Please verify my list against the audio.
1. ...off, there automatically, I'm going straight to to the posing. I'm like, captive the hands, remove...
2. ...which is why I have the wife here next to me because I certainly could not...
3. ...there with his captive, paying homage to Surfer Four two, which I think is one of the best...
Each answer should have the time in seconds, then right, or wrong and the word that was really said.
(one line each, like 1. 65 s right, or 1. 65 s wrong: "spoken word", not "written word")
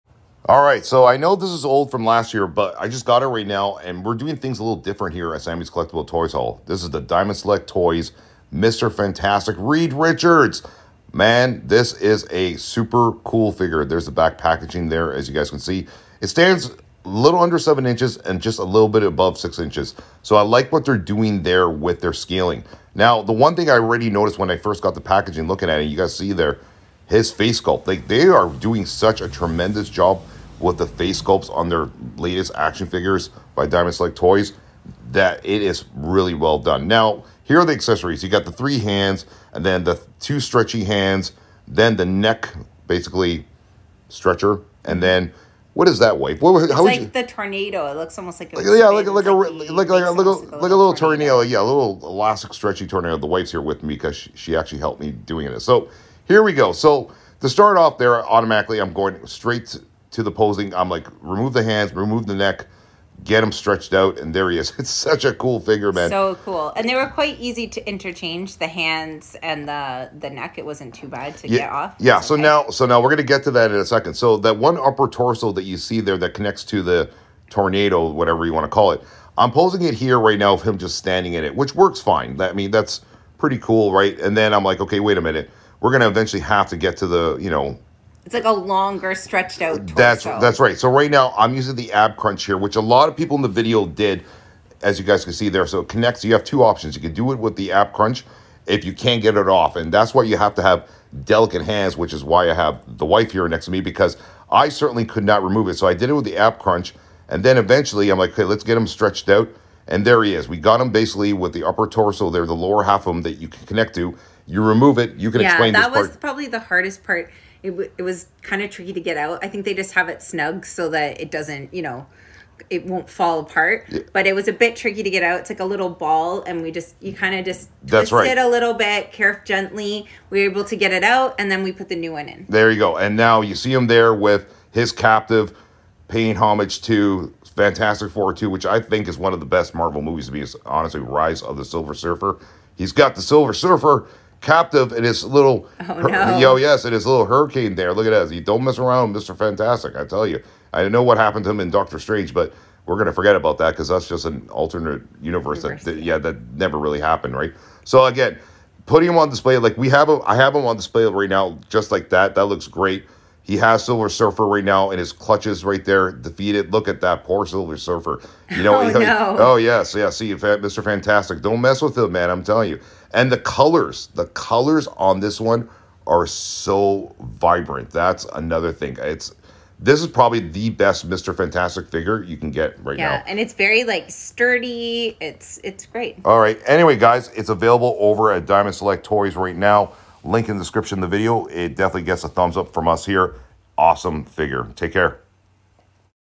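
1. 57 s wrong: "remove", not "captive"
2. 101 s right
3. 133 s wrong: "Fantastic", not "Surfer".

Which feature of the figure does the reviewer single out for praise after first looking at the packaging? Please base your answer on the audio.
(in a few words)
Face sculpt.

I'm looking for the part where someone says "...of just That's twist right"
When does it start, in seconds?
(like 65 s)
127 s.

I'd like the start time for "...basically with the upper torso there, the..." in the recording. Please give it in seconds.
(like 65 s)
110 s.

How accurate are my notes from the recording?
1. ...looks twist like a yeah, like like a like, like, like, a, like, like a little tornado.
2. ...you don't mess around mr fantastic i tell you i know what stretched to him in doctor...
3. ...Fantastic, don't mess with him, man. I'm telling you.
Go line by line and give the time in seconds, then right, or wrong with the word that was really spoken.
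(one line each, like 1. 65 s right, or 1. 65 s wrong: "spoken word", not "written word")
1. 47 s wrong: "almost", not "twist"
2. 148 s wrong: "happened", not "stretched"
3. 170 s right.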